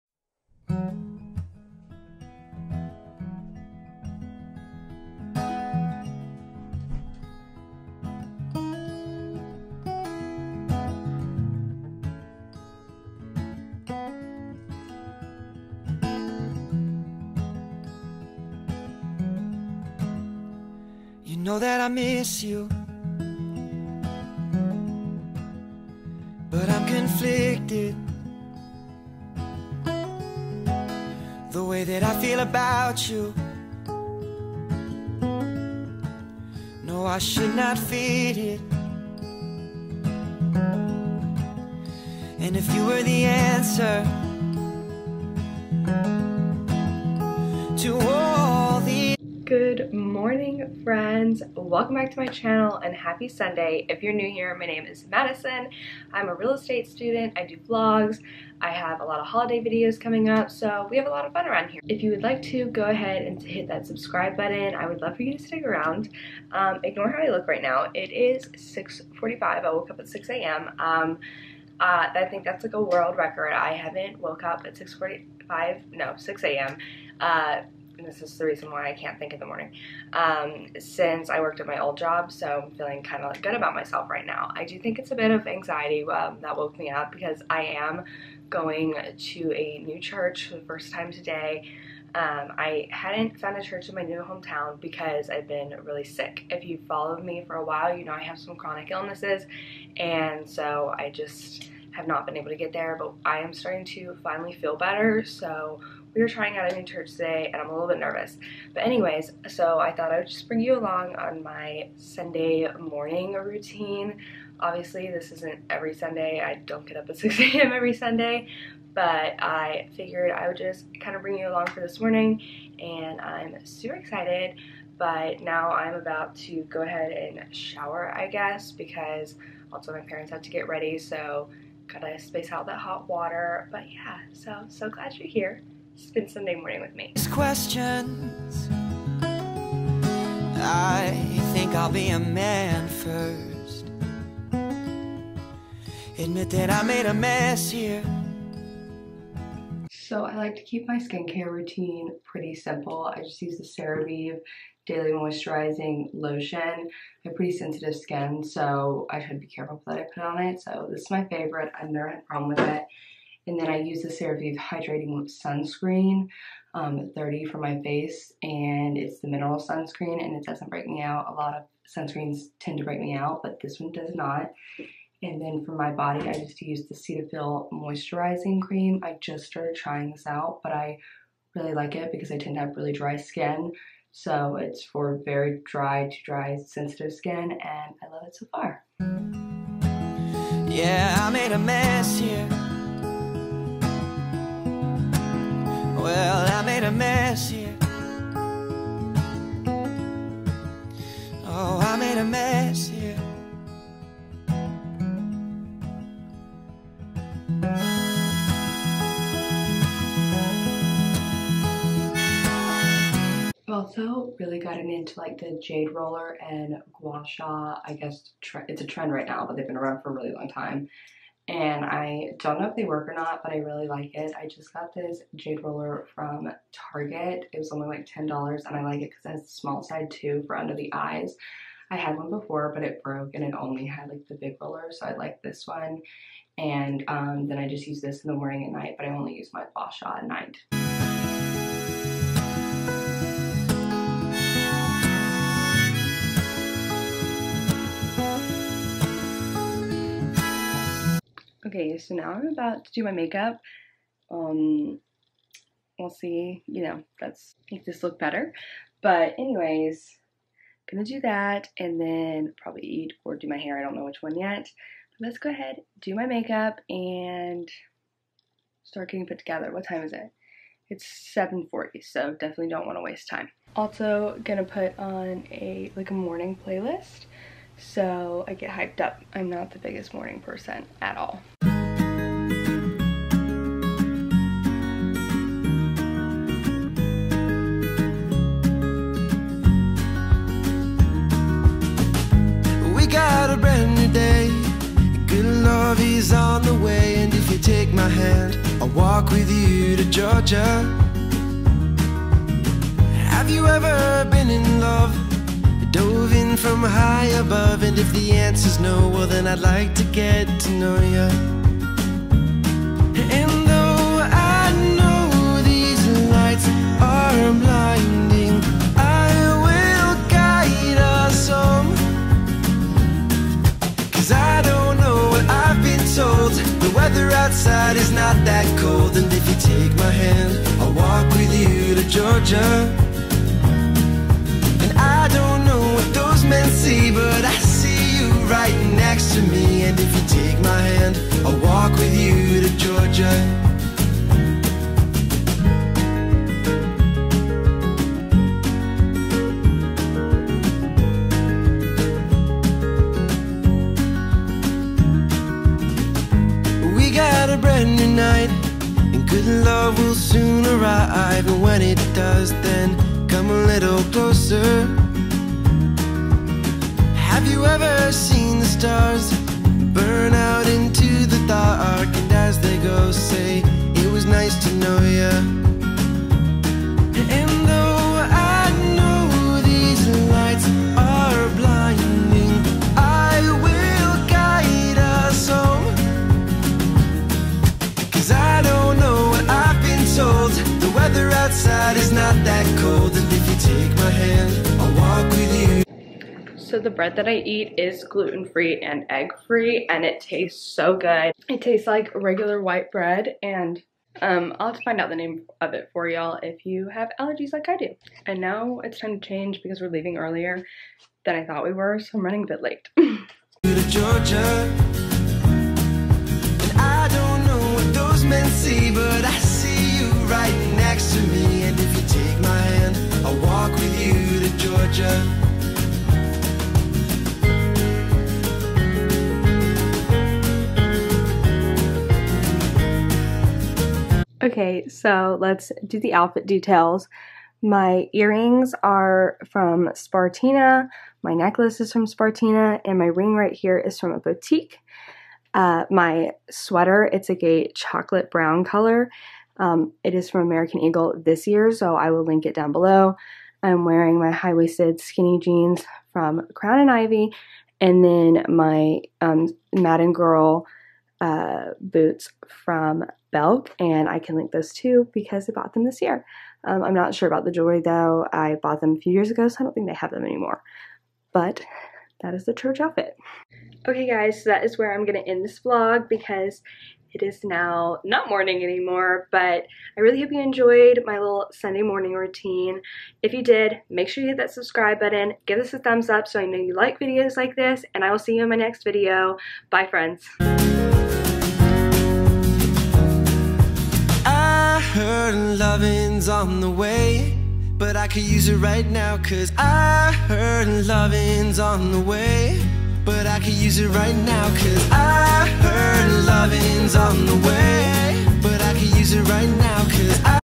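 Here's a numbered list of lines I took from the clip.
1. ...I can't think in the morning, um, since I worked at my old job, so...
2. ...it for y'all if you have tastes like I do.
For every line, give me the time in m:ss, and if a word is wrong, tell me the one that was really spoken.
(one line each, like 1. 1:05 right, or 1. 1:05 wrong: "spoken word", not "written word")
1. 1:18 right
2. 6:45 wrong: "allergies", not "tastes".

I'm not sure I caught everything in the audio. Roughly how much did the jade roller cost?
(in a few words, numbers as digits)
$10.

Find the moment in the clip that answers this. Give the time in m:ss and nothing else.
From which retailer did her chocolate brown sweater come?
7:30.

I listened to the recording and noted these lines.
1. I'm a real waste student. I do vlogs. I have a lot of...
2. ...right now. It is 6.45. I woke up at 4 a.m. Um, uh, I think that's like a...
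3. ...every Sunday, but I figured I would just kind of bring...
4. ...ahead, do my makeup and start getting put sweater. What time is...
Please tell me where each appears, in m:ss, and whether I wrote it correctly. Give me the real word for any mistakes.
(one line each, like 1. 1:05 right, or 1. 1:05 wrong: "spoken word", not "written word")
1. 0:56 wrong: "estate", not "waste"
2. 1:07 wrong: "6", not "4"
3. 1:57 right
4. 4:25 wrong: "together", not "sweater".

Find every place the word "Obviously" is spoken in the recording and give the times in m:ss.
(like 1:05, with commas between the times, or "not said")
1:54.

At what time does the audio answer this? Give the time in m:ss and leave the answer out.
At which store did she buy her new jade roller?
3:46.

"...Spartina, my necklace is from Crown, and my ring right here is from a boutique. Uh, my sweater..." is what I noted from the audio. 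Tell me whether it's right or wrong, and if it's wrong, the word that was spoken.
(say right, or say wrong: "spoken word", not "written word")
wrong: "Spartina", not "Crown".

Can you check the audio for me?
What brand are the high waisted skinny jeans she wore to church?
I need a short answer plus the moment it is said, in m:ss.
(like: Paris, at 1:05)
Crown and Ivy, at 7:36.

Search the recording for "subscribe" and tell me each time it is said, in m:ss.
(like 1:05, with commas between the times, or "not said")
1:03, 8:04.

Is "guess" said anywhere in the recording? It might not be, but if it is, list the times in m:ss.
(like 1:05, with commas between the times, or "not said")
2:08, 3:37.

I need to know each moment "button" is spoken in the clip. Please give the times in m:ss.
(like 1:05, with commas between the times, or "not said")
1:04, 8:04.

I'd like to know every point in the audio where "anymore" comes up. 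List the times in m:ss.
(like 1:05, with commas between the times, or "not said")
7:50, 7:58.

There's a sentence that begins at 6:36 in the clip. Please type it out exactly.
So the bread that I eat is gluten-free and egg-free and it tastes so good.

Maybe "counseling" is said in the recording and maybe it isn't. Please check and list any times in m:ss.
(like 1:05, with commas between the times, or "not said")
not said.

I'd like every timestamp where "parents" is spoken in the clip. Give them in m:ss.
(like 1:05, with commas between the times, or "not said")
2:10.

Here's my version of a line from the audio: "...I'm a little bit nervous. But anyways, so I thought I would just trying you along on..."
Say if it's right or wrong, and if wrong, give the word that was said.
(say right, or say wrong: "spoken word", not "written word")
wrong: "bring", not "trying".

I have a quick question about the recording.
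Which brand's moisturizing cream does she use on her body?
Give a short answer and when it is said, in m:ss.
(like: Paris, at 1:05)
Cetaphil, at 2:56.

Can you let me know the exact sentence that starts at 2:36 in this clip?
I have pretty sensitive skin, so I should be careful that I put on it.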